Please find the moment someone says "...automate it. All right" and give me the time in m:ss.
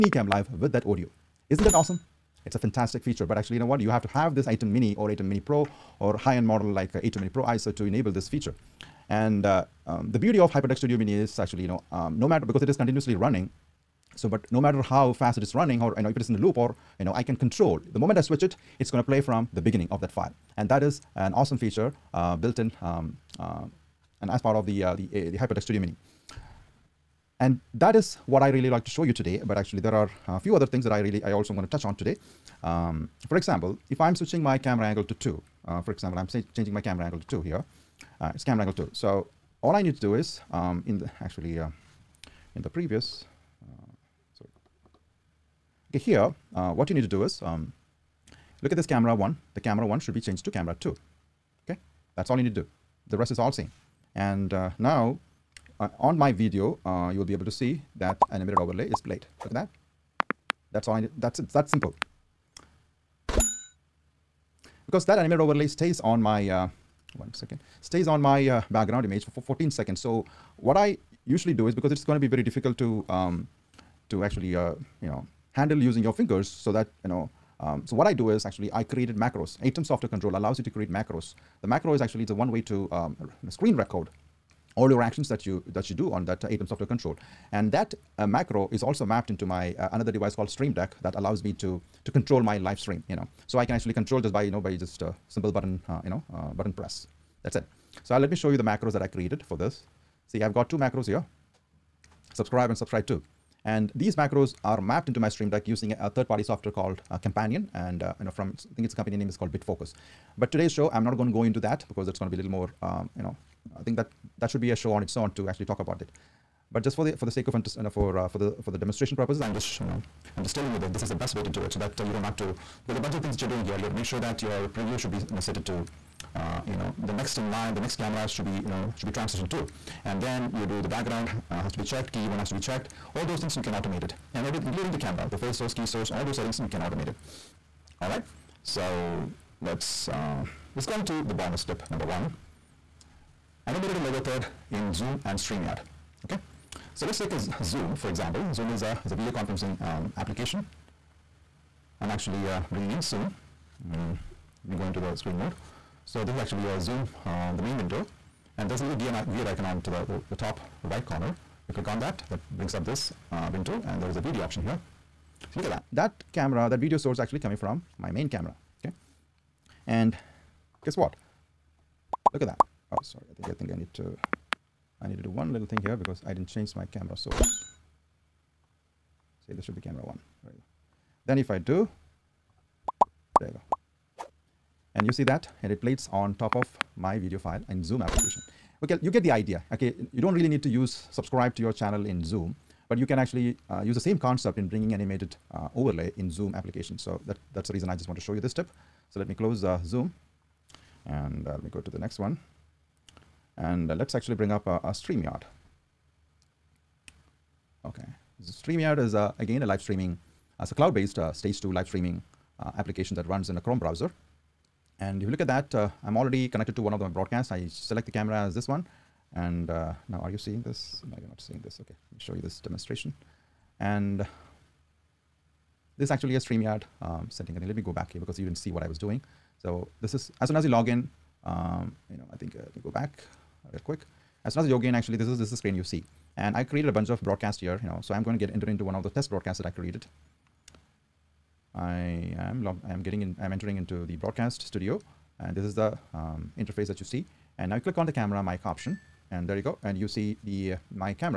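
2:16.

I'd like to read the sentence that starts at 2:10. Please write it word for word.
And then you do the background uh, has to be checked, key one has to be checked.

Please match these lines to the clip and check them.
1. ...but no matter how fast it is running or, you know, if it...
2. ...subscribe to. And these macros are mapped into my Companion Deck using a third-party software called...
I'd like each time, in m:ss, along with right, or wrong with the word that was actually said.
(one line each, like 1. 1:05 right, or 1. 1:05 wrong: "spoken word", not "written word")
1. 0:14 right
2. 1:42 wrong: "Stream", not "Companion".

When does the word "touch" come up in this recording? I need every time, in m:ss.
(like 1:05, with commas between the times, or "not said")
0:31.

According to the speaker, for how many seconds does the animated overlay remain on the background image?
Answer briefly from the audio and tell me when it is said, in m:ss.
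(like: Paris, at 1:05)
14 seconds, at 1:09.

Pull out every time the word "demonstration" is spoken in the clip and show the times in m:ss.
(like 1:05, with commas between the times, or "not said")
1:58, 3:42.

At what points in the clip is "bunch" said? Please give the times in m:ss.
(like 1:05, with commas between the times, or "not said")
2:02, 3:56.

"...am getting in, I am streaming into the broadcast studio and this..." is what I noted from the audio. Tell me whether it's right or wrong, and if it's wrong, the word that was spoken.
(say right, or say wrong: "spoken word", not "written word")
wrong: "entering", not "streaming".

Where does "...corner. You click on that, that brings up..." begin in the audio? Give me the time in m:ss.
2:41.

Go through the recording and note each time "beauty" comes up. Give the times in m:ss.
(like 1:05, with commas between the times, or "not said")
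0:10.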